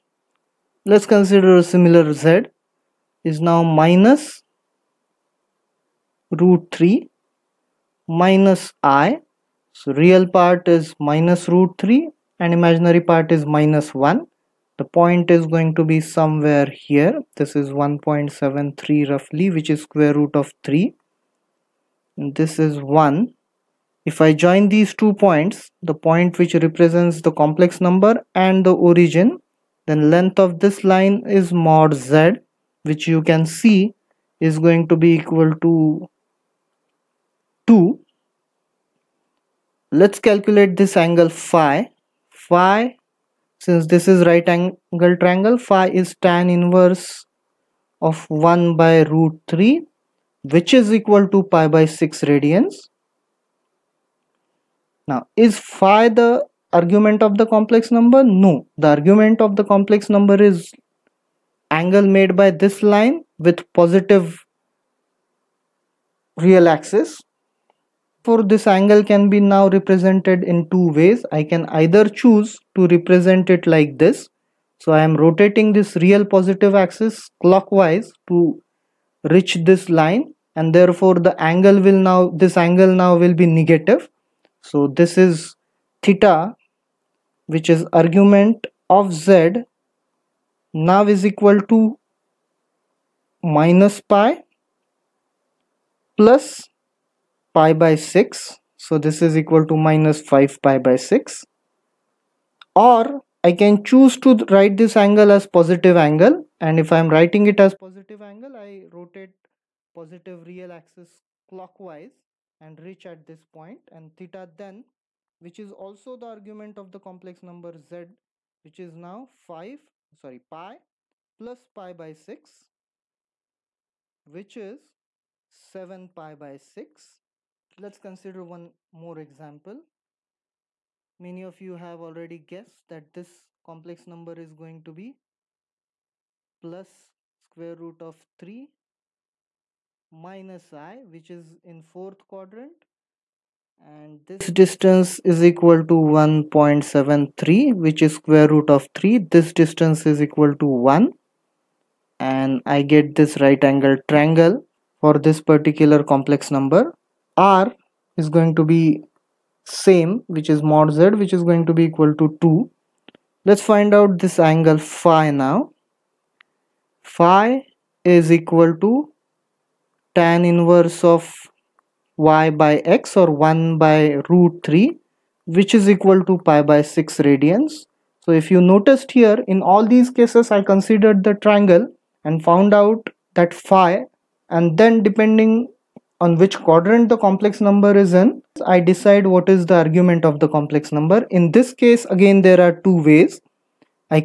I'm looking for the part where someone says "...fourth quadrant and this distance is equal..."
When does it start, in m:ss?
2:21.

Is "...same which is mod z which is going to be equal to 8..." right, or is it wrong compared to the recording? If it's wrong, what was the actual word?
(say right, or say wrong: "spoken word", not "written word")
wrong: "2", not "8".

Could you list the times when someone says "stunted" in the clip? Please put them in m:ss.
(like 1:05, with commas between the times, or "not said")
not said.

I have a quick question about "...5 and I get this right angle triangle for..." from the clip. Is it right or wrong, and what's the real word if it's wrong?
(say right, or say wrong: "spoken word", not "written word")
wrong: "1", not "5".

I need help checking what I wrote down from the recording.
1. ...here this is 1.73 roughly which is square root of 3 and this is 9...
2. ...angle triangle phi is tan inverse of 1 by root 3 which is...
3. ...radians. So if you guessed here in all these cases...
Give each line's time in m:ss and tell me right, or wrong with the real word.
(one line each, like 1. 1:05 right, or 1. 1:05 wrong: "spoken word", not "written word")
1. 0:16 wrong: "1", not "9"
2. 0:44 right
3. 2:57 wrong: "noticed", not "guessed".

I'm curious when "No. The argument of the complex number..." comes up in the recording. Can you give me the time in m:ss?
0:58.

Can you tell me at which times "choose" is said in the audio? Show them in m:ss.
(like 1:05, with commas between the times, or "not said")
1:12, 1:43.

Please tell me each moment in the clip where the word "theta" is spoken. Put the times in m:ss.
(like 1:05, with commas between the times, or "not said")
1:26, 1:54.